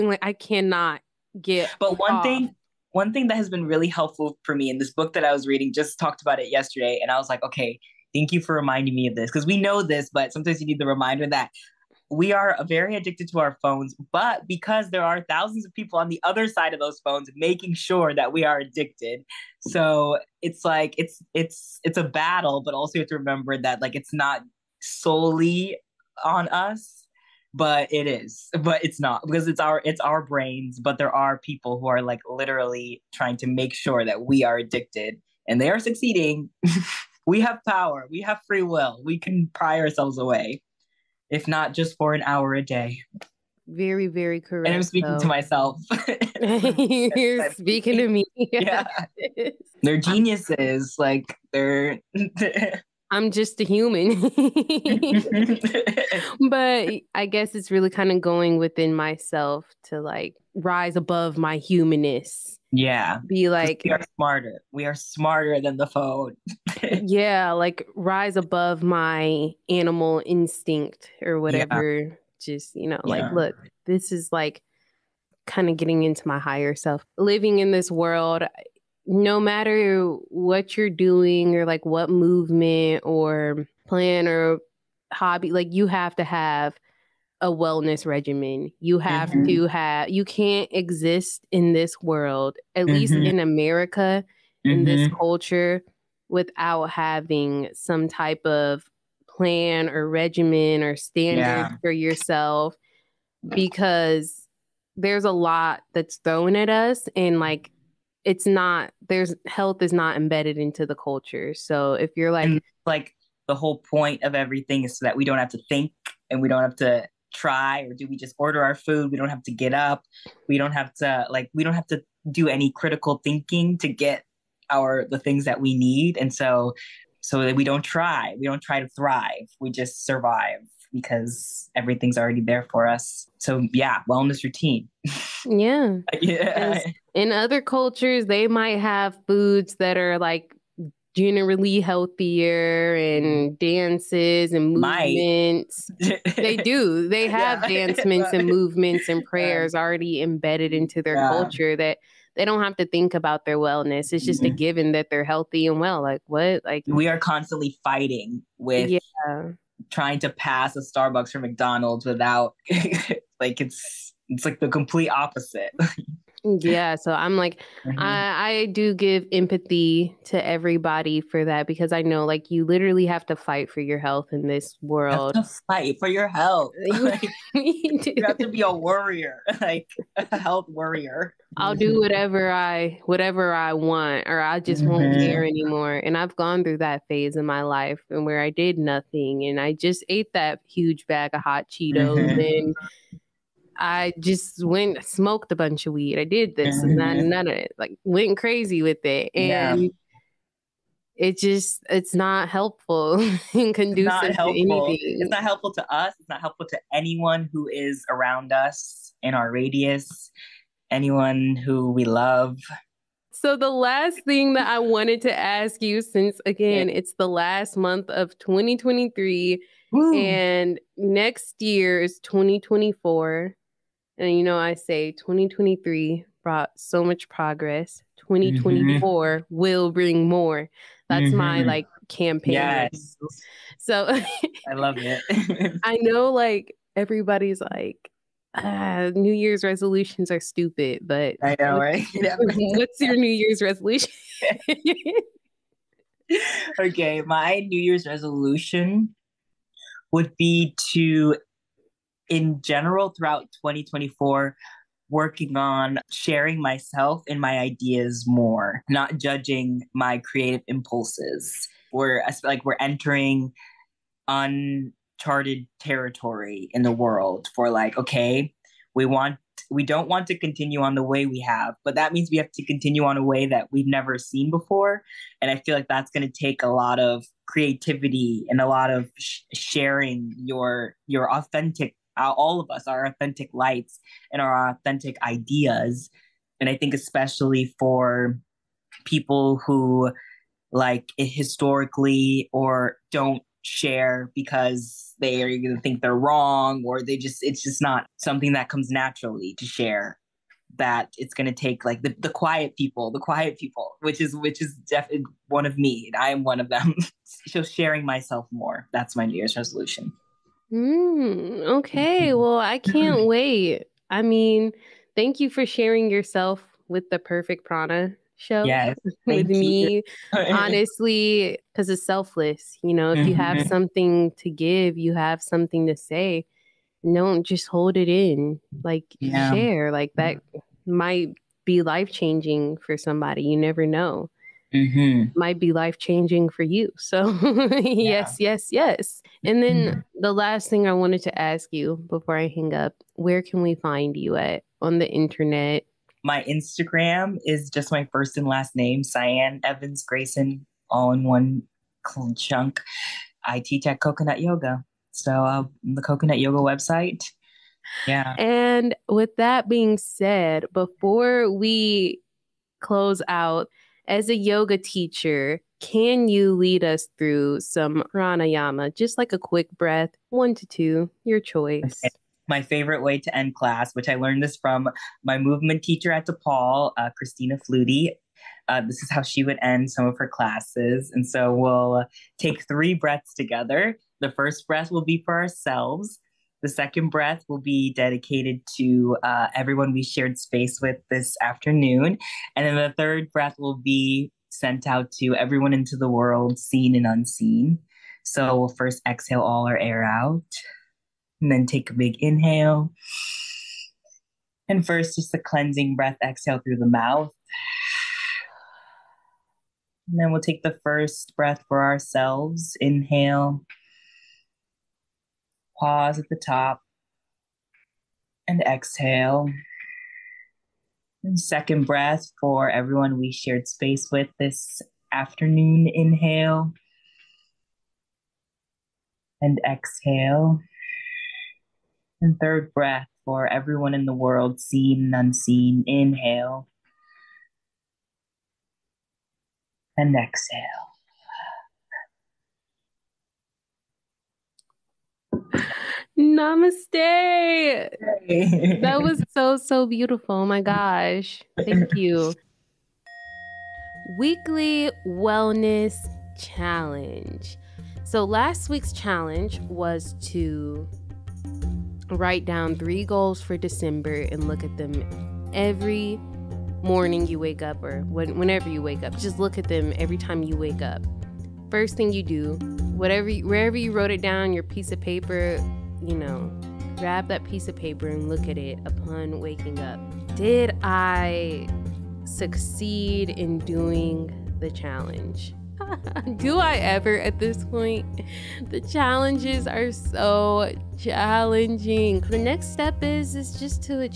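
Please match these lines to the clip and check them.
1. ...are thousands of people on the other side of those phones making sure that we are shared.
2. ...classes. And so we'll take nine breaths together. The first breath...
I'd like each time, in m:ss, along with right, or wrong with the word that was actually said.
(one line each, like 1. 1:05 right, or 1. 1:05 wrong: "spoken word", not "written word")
1. 0:15 wrong: "addicted", not "shared"
2. 6:20 wrong: "three", not "nine".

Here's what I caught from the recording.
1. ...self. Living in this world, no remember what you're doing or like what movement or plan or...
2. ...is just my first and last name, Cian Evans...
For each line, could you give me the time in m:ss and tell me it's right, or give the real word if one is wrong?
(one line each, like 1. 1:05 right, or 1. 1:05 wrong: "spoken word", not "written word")
1. 1:16 wrong: "matter", not "remember"
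2. 5:47 right.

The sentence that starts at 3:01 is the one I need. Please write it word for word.
I'll do whatever I whatever I want or I just mm-hmm.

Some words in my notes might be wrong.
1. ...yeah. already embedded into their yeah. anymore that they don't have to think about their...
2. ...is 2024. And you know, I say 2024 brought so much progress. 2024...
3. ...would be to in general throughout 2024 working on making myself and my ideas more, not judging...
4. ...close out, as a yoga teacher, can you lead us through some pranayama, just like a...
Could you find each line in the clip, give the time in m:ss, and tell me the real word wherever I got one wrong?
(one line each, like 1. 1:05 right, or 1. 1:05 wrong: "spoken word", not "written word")
1. 2:29 wrong: "culture", not "anymore"
2. 3:42 wrong: "2023", not "2024"
3. 4:10 wrong: "sharing", not "making"
4. 6:02 right.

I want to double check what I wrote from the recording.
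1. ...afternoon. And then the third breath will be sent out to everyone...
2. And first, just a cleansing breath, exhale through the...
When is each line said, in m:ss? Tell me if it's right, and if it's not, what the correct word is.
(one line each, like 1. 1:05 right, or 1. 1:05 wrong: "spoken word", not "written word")
1. 6:31 right
2. 6:44 right.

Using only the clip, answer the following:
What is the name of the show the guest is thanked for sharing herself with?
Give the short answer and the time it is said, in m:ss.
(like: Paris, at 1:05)
Perfect Prana, at 5:17.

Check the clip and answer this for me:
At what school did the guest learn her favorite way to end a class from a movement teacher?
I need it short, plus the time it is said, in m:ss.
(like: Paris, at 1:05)
DePaul, at 6:16.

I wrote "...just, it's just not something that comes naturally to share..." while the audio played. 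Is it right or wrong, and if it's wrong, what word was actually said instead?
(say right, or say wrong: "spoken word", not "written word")
right.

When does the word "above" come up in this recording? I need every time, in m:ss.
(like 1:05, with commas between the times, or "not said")
1:00, 1:08.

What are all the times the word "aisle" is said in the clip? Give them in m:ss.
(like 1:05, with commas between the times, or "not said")
not said.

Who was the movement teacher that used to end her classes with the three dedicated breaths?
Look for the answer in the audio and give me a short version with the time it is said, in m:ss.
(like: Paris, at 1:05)
Christina Flutie, at 6:17.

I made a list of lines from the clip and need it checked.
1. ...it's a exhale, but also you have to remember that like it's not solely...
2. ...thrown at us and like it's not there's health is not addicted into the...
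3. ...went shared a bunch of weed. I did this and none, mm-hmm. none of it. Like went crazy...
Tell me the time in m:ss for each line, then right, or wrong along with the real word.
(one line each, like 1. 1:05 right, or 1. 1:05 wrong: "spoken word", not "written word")
1. 0:21 wrong: "battle", not "exhale"
2. 1:46 wrong: "embedded", not "addicted"
3. 3:14 wrong: "smoked", not "shared".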